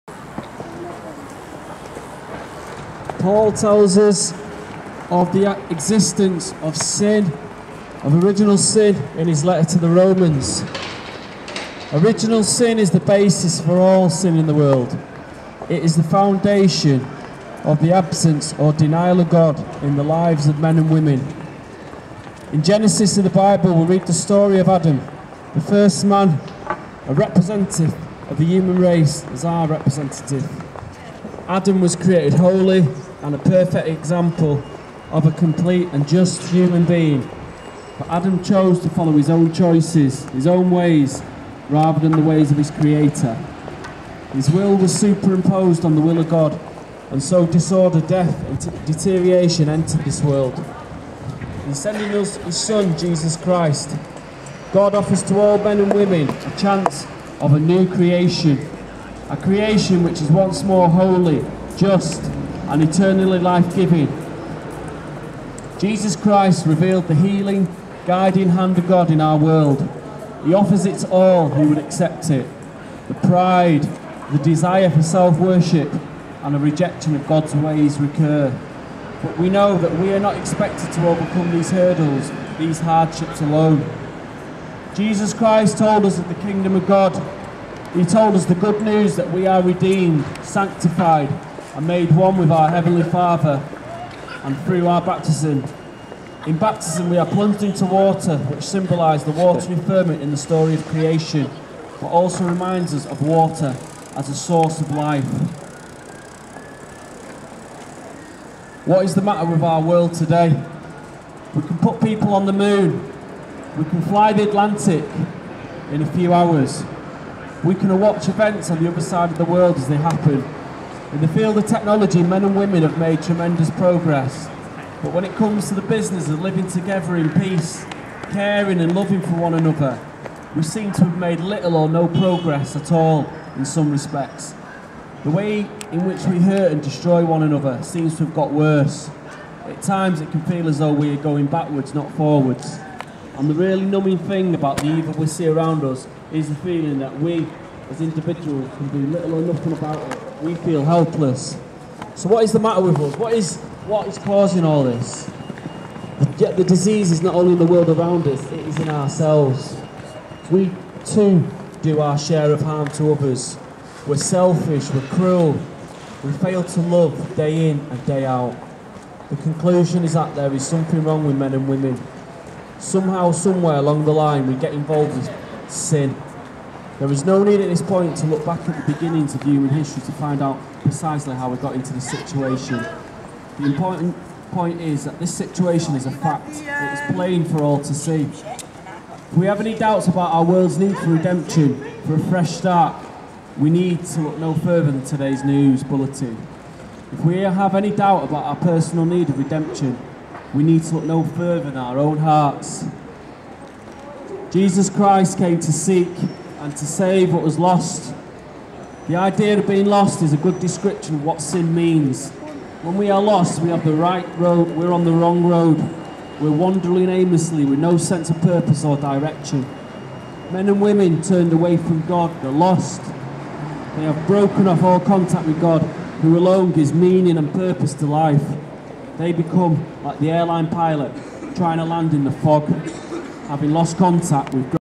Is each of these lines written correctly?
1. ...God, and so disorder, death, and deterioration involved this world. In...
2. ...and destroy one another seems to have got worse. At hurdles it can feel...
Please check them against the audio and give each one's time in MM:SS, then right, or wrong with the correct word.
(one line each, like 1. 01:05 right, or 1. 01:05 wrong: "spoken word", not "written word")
1. 00:46 wrong: "entered", not "involved"
2. 02:16 wrong: "times", not "hurdles".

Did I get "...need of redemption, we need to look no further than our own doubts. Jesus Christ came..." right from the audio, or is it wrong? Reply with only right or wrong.
wrong.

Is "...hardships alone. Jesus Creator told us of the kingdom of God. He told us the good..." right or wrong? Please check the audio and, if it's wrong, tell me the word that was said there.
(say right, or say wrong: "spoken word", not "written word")
wrong: "Christ", not "Creator".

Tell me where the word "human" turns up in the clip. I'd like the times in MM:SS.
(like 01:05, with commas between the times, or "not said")
00:28, 00:36, 02:59.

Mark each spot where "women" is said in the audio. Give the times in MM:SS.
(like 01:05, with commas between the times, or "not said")
00:20, 00:55, 02:02, 02:51, 03:40.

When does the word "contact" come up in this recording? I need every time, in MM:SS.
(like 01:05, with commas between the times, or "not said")
03:44, 03:53.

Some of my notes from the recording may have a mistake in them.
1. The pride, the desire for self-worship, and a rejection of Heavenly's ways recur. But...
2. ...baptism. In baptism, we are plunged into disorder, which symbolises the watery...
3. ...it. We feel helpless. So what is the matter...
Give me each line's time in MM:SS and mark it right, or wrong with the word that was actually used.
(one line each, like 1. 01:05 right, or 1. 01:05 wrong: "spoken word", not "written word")
1. 01:13 wrong: "God", not "Heavenly"
2. 01:35 wrong: "water", not "disorder"
3. 02:30 right.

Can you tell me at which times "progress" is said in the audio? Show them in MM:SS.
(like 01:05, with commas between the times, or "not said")
02:03, 02:12.